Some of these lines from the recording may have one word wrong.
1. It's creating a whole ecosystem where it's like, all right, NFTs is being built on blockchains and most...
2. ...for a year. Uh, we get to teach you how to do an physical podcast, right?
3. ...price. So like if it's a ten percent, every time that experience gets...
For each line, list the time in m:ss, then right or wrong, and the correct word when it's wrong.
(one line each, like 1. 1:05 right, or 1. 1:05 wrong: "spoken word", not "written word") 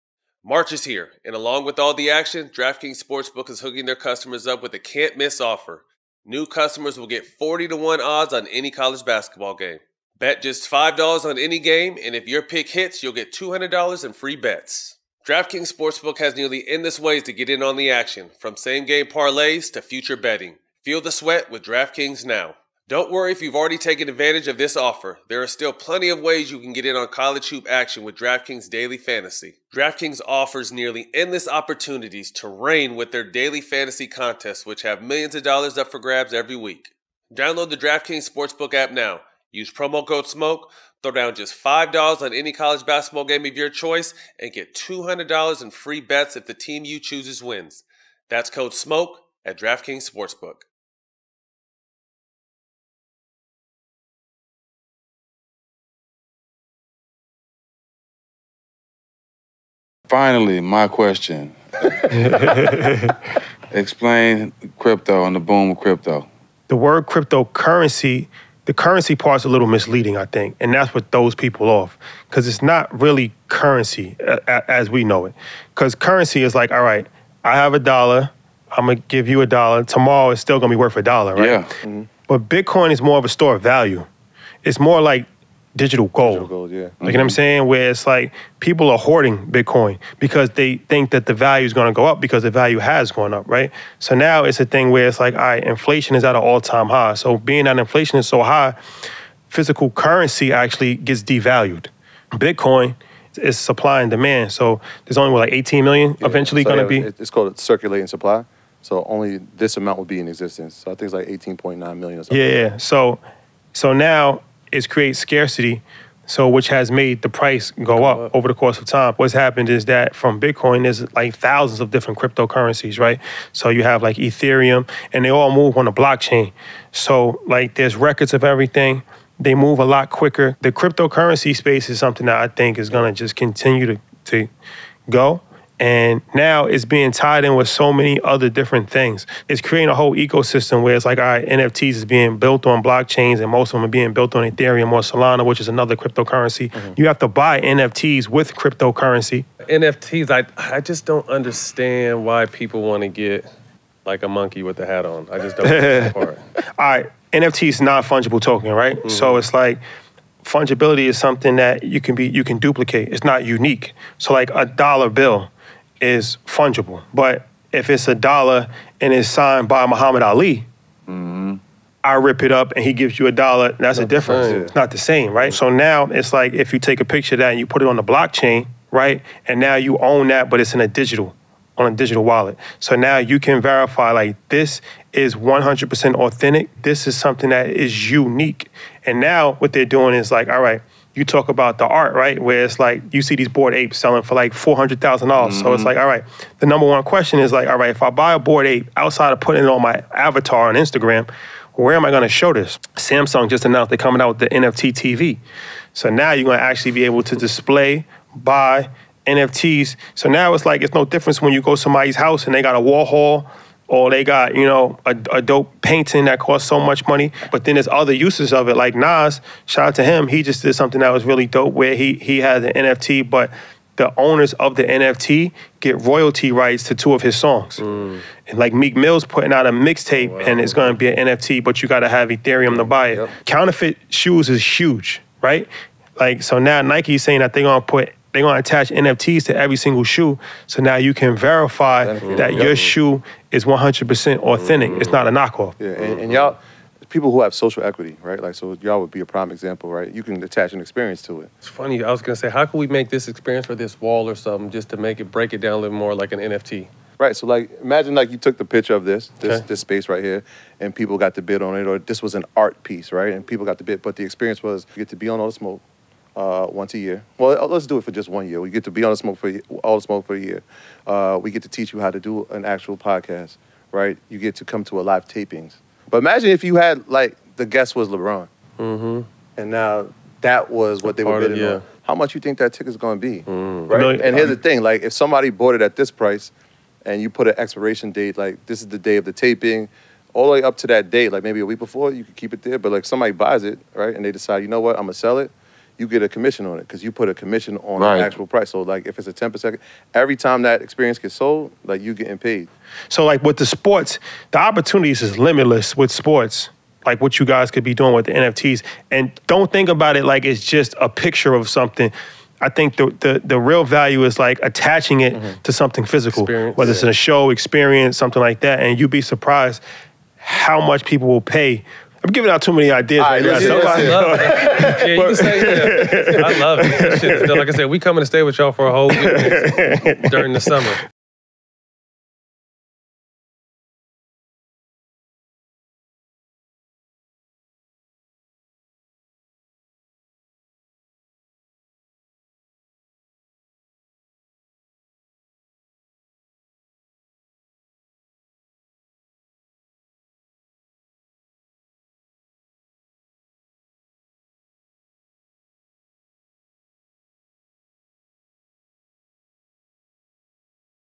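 1. 2:19 right
2. 4:30 wrong: "actual", not "physical"
3. 4:58 right.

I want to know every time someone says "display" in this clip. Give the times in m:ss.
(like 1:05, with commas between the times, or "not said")
3:27.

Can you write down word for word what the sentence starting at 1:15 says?
Because currency is like, all right, I have a dollar, I'm gonna give you a dollar.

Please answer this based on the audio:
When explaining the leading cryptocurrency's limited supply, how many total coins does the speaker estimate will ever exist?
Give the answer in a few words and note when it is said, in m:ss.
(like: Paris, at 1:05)
18.9 million, at 1:51.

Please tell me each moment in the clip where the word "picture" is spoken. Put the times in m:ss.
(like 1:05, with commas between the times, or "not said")
2:57, 4:18, 5:11.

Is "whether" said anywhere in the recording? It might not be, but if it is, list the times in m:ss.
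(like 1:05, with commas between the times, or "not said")
5:16.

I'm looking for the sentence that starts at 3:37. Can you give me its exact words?
But then there's other uses of it.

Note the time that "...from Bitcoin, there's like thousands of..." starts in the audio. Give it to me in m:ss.
2:00.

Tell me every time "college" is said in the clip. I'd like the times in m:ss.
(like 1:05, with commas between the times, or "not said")
0:08, 0:27, 0:42.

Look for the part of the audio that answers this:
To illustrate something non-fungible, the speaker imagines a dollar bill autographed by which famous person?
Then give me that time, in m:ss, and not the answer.
2:49.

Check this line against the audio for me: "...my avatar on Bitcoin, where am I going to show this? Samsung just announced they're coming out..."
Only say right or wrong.
wrong.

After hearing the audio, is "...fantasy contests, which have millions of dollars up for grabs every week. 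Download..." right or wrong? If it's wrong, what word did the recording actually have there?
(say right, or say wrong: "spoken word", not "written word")
right.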